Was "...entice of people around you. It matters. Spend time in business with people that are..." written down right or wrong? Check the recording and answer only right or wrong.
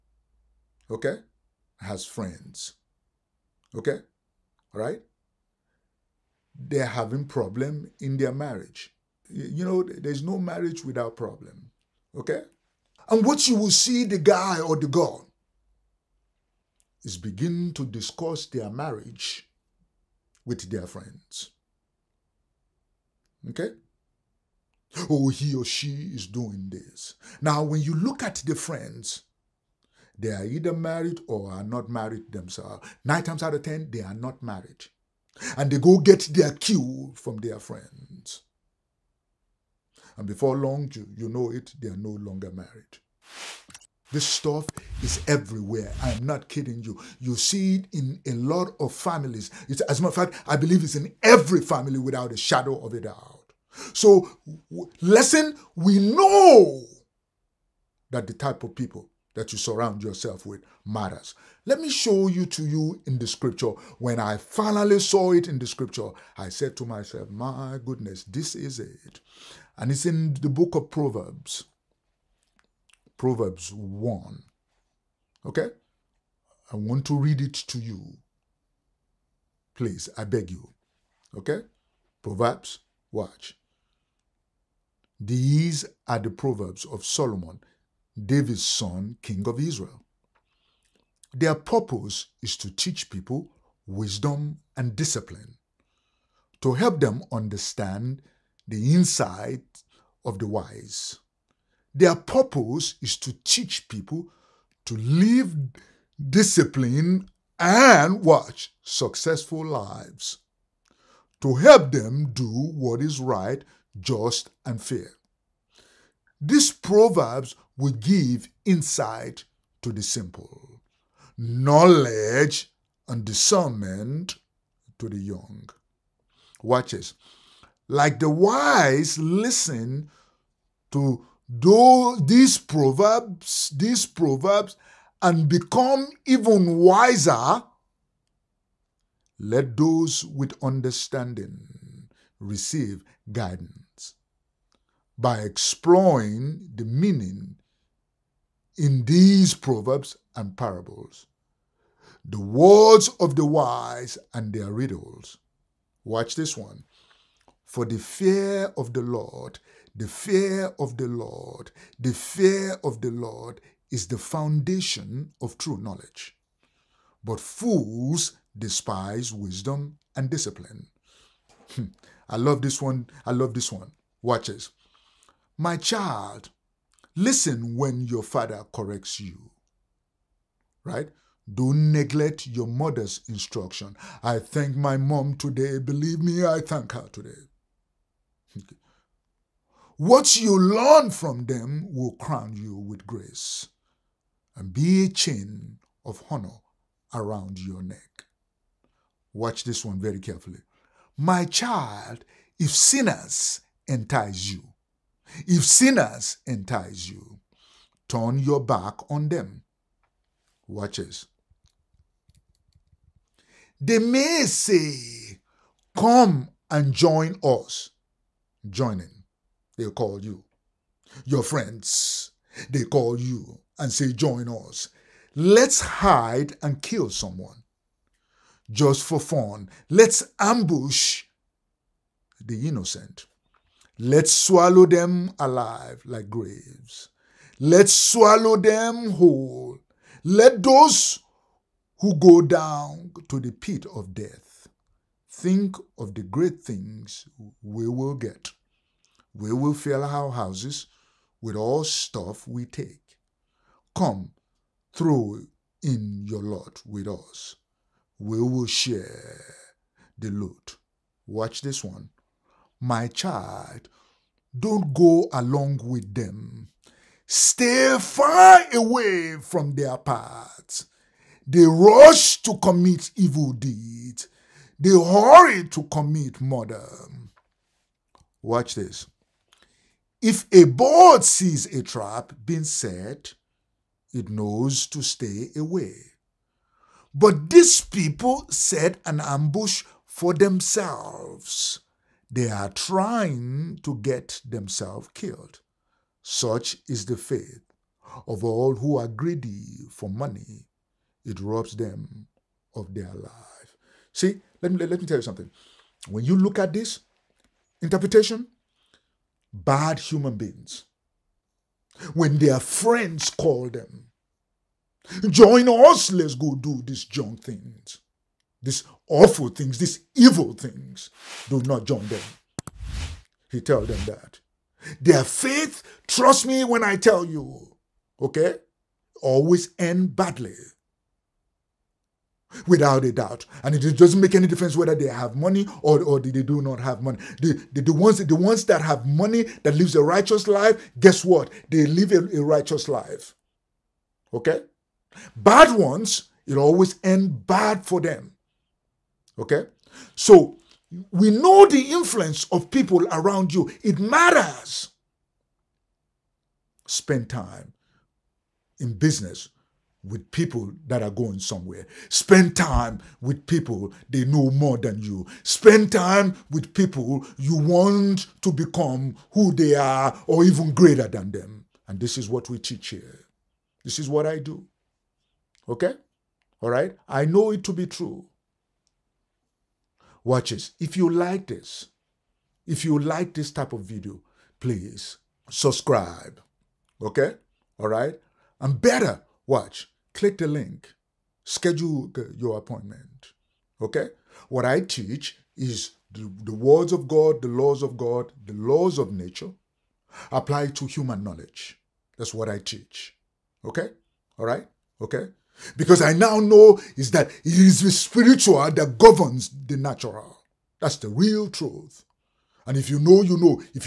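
wrong.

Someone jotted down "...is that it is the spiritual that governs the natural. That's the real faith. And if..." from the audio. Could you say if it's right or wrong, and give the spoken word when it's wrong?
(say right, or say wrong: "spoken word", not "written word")
wrong: "truth", not "faith".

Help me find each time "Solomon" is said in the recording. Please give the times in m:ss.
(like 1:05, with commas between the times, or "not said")
1:27.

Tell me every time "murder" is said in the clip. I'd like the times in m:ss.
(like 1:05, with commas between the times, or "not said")
4:36.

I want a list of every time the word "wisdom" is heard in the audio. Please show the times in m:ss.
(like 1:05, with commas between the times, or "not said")
1:33, 2:49.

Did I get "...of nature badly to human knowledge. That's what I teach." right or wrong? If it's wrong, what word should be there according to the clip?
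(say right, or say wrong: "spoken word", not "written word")
wrong: "apply", not "badly".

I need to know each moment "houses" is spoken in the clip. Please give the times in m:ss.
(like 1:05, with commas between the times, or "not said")
4:10.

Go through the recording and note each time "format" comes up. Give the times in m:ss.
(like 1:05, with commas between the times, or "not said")
not said.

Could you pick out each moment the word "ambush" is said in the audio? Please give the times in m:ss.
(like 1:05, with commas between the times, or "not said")
3:50, 4:49.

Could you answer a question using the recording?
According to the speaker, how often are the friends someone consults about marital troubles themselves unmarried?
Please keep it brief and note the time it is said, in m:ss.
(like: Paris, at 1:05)
9 times out of 10, at 0:33.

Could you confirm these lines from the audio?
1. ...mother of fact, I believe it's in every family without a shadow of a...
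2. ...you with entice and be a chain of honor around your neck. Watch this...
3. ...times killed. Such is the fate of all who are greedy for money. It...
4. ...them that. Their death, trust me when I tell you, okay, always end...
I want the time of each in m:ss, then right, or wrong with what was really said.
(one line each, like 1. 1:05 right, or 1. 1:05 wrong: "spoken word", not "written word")
1. 0:50 wrong: "matter", not "mother"
2. 3:12 wrong: "grace", not "entice"
3. 4:54 wrong: "themselves", not "times"
4. 5:23 wrong: "faith", not "death".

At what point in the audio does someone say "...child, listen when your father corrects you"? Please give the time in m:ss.
2:55.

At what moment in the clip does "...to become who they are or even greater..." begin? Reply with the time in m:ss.
6:08.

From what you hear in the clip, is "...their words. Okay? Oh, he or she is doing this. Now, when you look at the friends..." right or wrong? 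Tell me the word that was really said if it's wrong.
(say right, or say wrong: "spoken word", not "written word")
wrong: "friends", not "words".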